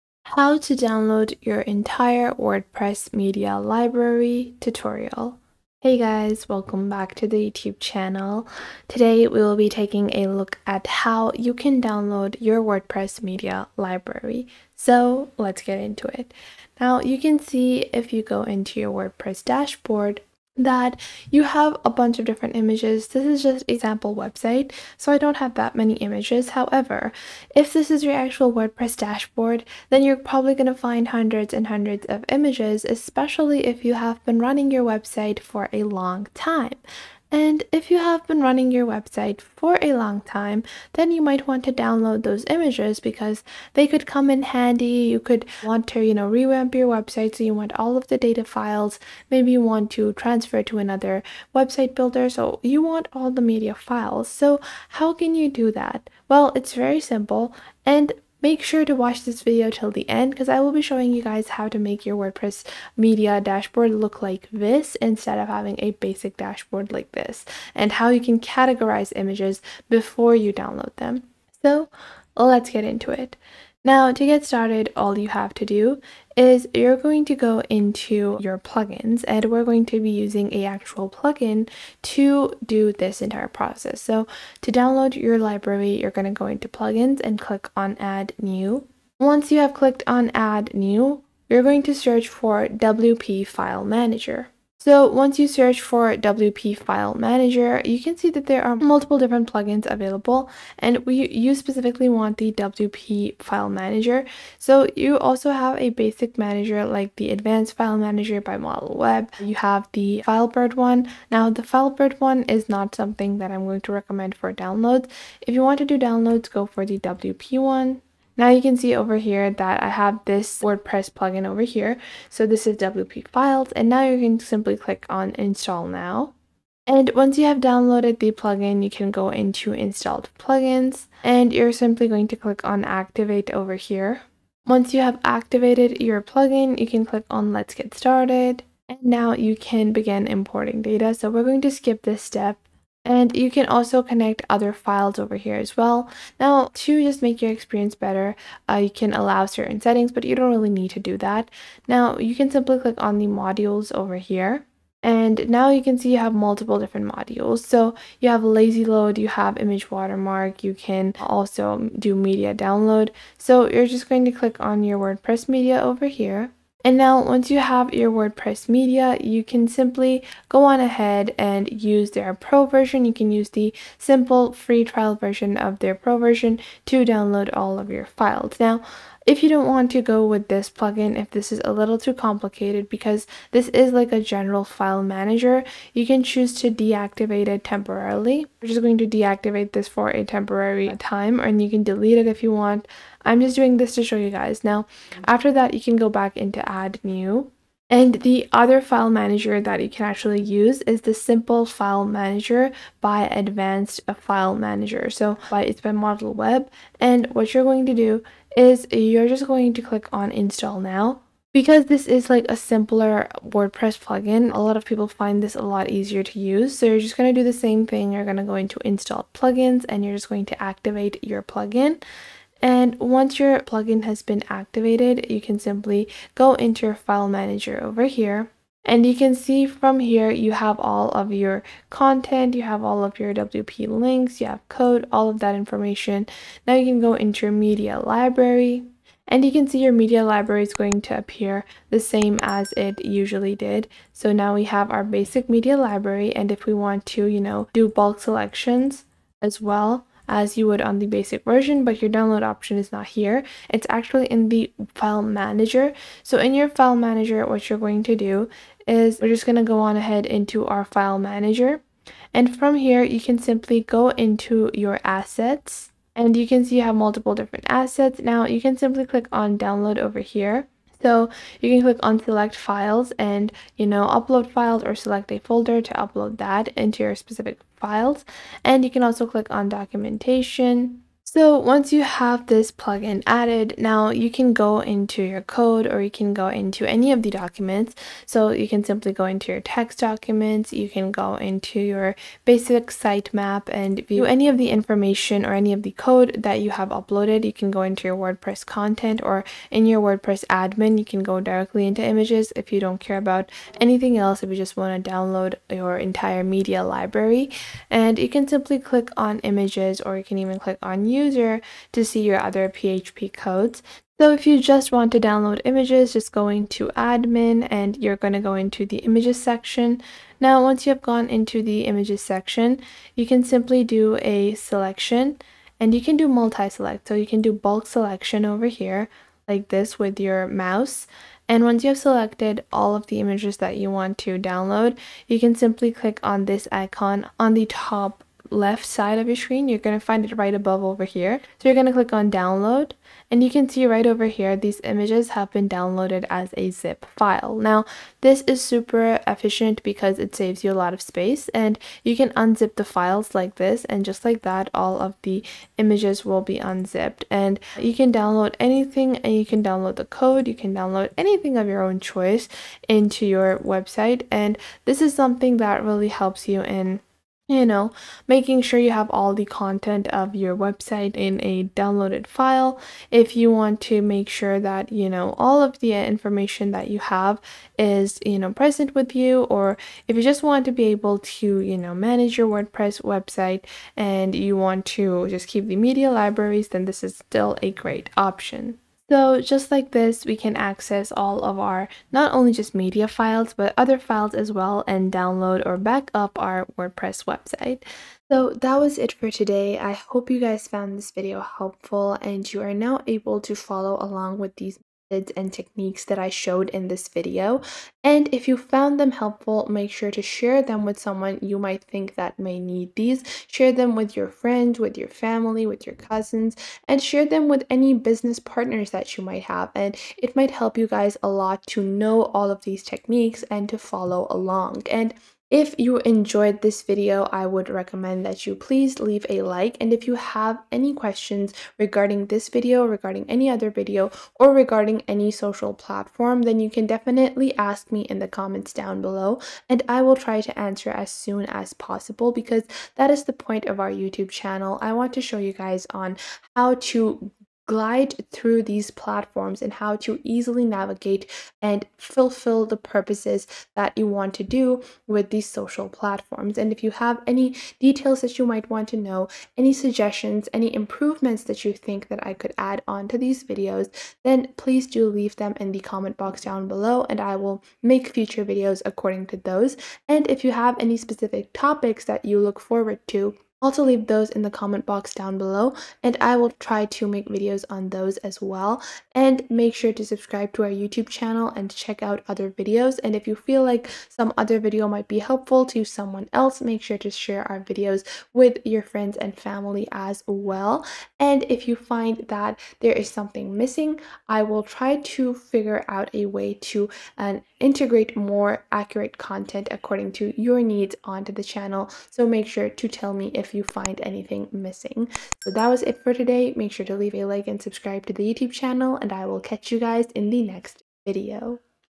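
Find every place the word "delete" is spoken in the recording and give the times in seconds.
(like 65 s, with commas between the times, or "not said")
191 s.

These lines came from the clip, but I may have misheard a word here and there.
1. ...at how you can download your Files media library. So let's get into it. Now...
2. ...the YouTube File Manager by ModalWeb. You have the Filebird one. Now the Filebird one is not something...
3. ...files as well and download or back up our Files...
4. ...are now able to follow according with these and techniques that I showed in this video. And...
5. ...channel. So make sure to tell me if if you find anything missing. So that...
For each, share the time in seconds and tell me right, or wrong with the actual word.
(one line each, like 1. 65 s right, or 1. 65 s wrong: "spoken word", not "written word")
1. 10 s wrong: "WordPress", not "Files"
2. 107 s wrong: "Advanced", not "YouTube"
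3. 393 s wrong: "WordPress", not "Files"
4. 402 s wrong: "along", not "according"
5. 501 s right.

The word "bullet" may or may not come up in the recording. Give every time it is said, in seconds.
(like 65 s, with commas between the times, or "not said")
not said.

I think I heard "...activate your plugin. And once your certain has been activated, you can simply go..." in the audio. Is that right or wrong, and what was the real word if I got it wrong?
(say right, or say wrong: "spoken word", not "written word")
wrong: "plugin", not "certain".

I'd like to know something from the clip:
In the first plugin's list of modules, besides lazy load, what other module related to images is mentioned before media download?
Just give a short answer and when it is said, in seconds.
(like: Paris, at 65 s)
Image watermark, at 159 s.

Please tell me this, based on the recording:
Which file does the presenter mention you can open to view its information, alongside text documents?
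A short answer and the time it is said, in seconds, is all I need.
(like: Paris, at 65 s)
sitemap, at 292 s.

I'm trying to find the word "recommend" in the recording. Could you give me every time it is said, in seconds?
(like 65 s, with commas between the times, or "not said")
113 s, 427 s.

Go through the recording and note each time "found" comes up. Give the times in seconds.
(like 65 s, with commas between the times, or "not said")
400 s, 408 s.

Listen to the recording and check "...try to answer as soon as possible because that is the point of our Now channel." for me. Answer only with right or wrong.
wrong.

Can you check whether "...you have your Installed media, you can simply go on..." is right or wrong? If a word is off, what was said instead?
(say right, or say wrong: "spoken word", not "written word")
wrong: "WordPress", not "Installed".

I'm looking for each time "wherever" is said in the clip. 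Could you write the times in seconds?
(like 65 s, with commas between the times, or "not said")
not said.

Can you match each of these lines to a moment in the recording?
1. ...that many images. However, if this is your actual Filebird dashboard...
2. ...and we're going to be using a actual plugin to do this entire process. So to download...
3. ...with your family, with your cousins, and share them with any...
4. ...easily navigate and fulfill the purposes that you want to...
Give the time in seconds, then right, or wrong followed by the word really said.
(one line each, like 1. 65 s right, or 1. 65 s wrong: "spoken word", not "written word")
1. 25 s wrong: "WordPress", not "Filebird"
2. 79 s right
3. 414 s right
4. 450 s right.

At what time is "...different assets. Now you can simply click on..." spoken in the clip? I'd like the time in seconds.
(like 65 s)
267 s.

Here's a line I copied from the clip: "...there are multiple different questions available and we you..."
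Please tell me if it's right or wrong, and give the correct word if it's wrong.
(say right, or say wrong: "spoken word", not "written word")
wrong: "plugins", not "questions".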